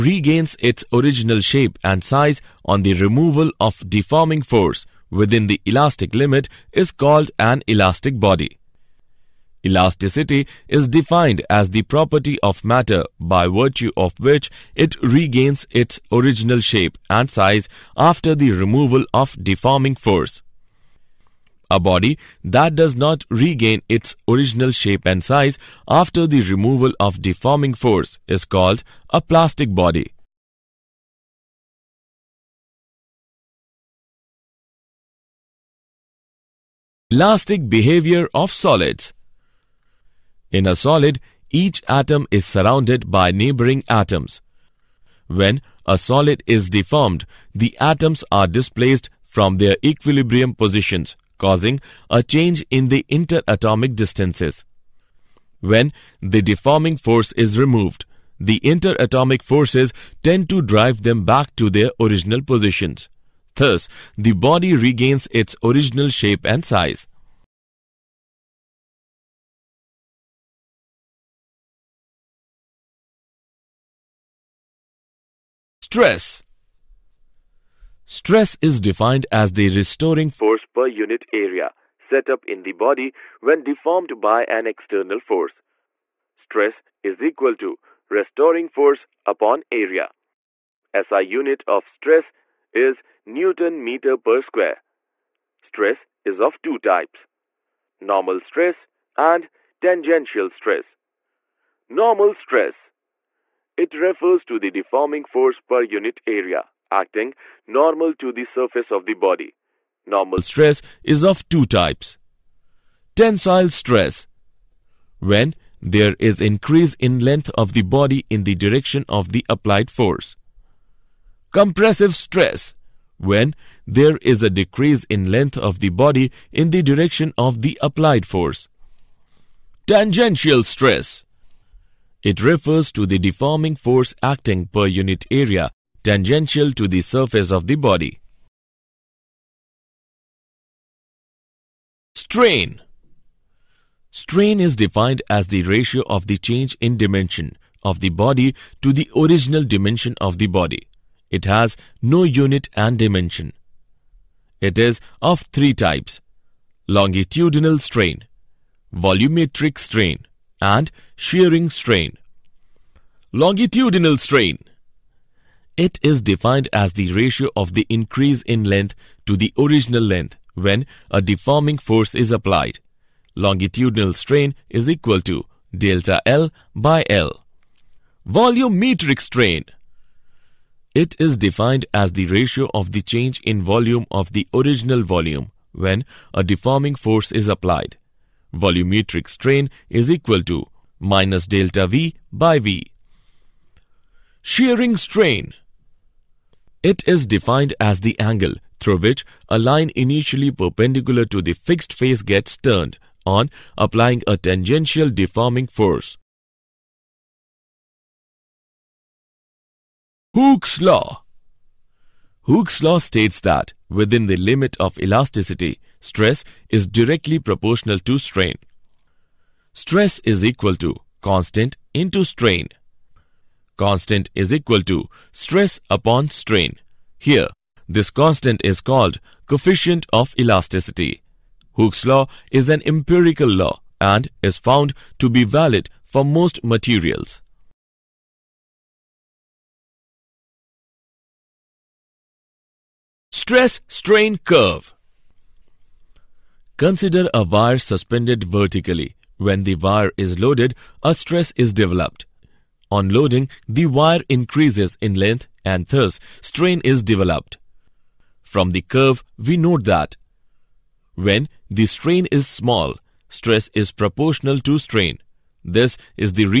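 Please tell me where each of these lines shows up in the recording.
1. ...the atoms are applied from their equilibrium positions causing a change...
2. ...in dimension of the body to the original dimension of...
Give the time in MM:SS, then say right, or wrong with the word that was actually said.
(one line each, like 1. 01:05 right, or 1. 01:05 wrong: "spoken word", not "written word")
1. 00:47 wrong: "displaced", not "applied"
2. 02:26 right.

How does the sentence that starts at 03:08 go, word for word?
Volumetric strain is equal to minus delta V by V.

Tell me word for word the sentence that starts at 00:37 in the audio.
Elastic behavior of solids In a solid, each atom is surrounded by neighboring atoms.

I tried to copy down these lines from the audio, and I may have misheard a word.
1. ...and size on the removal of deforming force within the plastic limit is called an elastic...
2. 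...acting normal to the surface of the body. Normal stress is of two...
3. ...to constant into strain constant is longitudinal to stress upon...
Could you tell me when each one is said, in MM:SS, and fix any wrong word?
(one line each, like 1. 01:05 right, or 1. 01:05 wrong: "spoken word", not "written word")
1. 00:01 wrong: "elastic", not "plastic"
2. 01:46 right
3. 03:40 wrong: "equal", not "longitudinal".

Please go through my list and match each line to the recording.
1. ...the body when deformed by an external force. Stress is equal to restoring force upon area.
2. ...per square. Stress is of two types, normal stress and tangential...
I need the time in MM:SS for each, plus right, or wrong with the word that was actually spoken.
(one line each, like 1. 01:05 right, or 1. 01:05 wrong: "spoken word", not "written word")
1. 01:22 right
2. 01:34 right.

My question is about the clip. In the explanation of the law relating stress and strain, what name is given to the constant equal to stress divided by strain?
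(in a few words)
coefficient of elasticity.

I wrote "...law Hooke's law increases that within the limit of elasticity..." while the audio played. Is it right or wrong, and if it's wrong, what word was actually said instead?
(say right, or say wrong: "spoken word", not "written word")
wrong: "states", not "increases".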